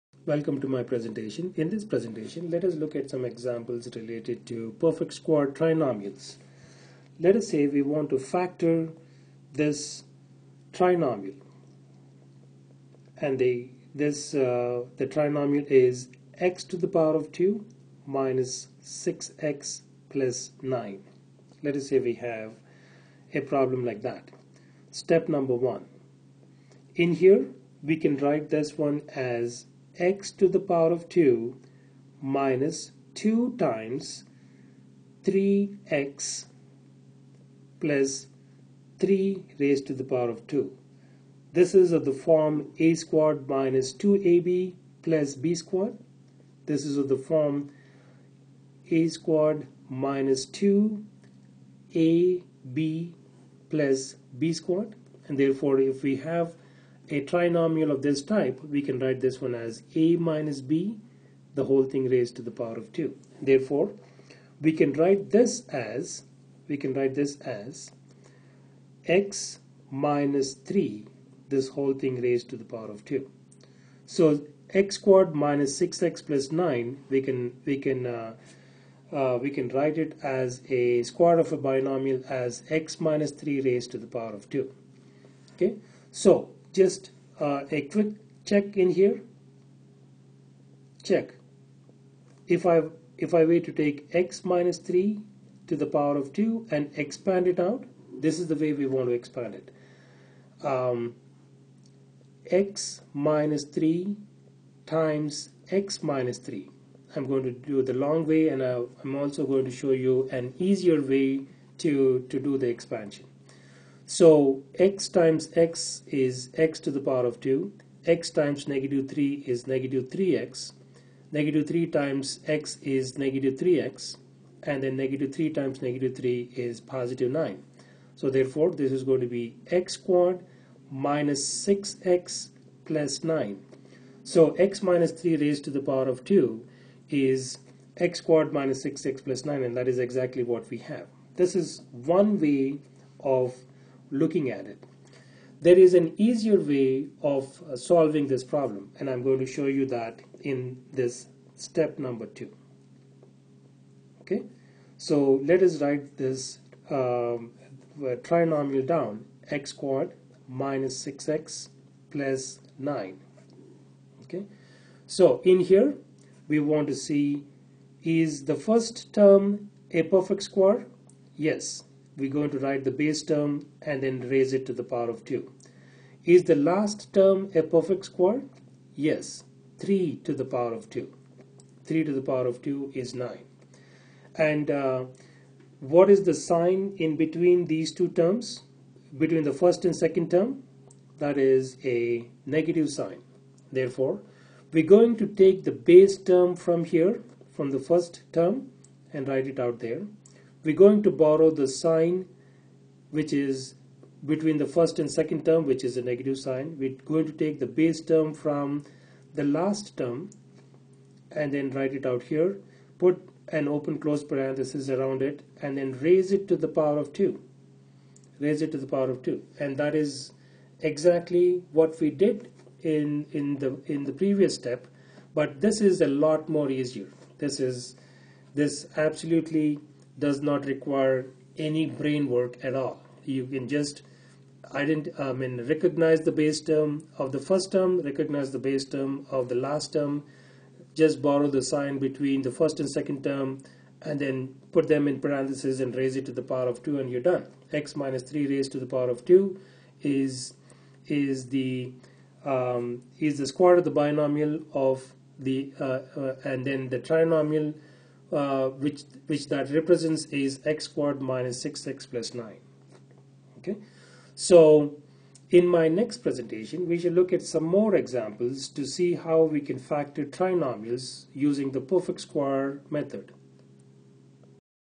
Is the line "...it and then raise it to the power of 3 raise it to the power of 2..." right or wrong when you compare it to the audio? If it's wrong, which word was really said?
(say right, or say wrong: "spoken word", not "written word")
wrong: "2", not "3".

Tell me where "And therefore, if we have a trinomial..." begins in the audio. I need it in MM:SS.
00:55.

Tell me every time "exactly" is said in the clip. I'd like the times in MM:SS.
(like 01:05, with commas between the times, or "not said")
02:19, 03:40.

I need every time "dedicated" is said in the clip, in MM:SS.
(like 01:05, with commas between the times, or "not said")
not said.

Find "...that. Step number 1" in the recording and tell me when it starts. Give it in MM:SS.
00:24.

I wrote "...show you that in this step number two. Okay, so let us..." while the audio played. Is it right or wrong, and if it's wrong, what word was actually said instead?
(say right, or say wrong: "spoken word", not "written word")
right.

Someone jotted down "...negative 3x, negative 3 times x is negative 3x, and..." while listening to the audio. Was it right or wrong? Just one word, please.
right.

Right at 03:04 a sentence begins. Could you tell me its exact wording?
And uh, what is the sign in between these two terms?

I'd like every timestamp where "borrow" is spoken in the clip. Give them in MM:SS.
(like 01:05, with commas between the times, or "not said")
03:21, 04:01.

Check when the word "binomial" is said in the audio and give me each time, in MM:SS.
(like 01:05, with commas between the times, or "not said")
01:21, 04:13.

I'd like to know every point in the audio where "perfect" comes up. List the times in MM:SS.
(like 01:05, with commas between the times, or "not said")
00:04, 02:50, 02:57, 04:31.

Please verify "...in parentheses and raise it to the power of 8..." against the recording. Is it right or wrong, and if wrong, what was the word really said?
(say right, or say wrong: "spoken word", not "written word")
wrong: "2", not "8".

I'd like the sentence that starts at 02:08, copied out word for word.
So therefore, this is going to be x squared minus 6x plus 9.